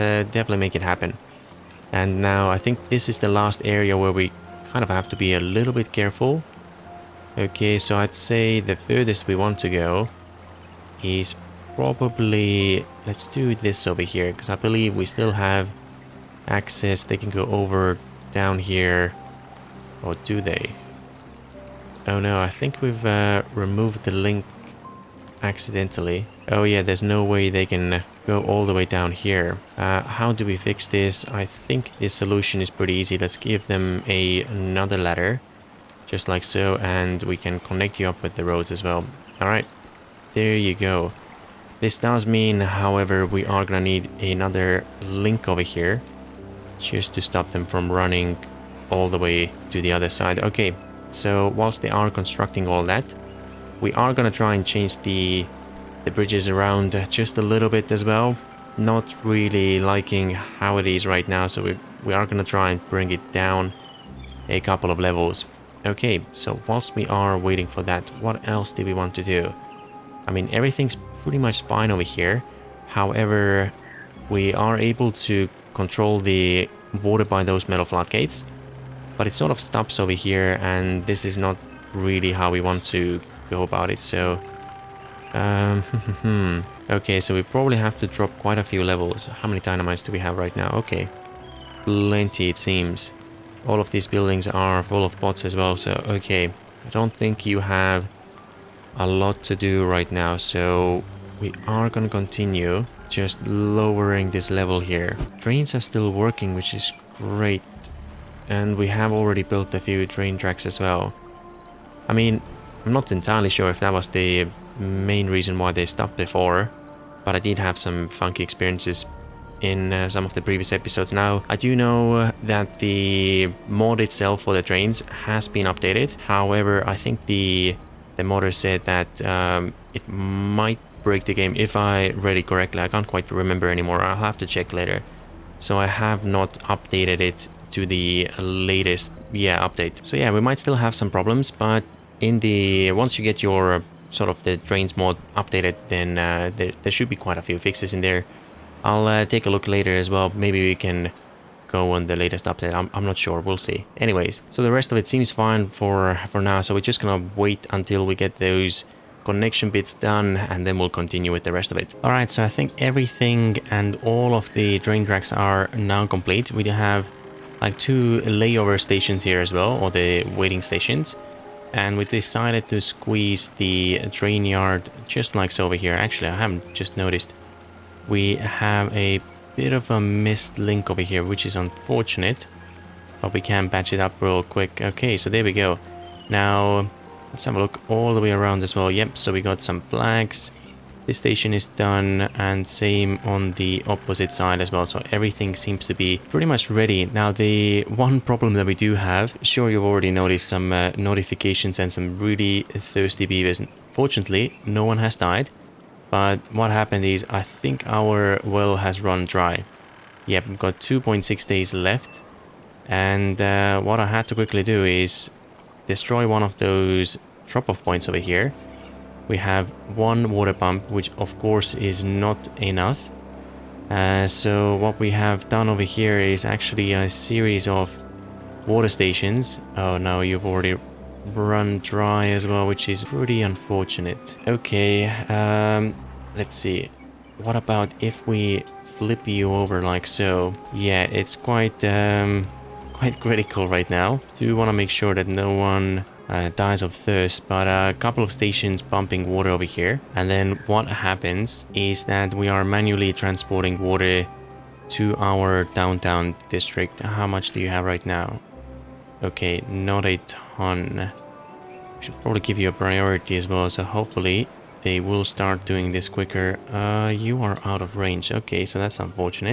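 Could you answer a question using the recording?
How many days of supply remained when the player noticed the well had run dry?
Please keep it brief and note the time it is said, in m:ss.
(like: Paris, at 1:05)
2.6 days, at 3:30.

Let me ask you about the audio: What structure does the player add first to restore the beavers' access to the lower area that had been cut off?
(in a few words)
ladder.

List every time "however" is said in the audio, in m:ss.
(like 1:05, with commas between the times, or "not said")
0:42, 1:12, 2:06.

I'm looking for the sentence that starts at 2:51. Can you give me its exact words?
And we decided to squeeze the train yard just like so over here.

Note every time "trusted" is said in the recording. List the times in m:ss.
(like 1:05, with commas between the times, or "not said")
not said.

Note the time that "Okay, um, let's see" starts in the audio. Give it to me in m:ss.
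3:54.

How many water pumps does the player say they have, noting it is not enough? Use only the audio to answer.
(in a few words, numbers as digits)
1.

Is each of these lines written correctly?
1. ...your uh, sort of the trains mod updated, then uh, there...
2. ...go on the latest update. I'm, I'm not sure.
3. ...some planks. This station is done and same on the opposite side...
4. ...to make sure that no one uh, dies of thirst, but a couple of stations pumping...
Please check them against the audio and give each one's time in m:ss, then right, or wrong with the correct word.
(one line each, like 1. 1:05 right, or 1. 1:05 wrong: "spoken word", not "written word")
1. 2:23 right
2. 2:31 right
3. 3:09 right
4. 4:04 right.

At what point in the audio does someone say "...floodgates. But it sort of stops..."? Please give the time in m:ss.
1:17.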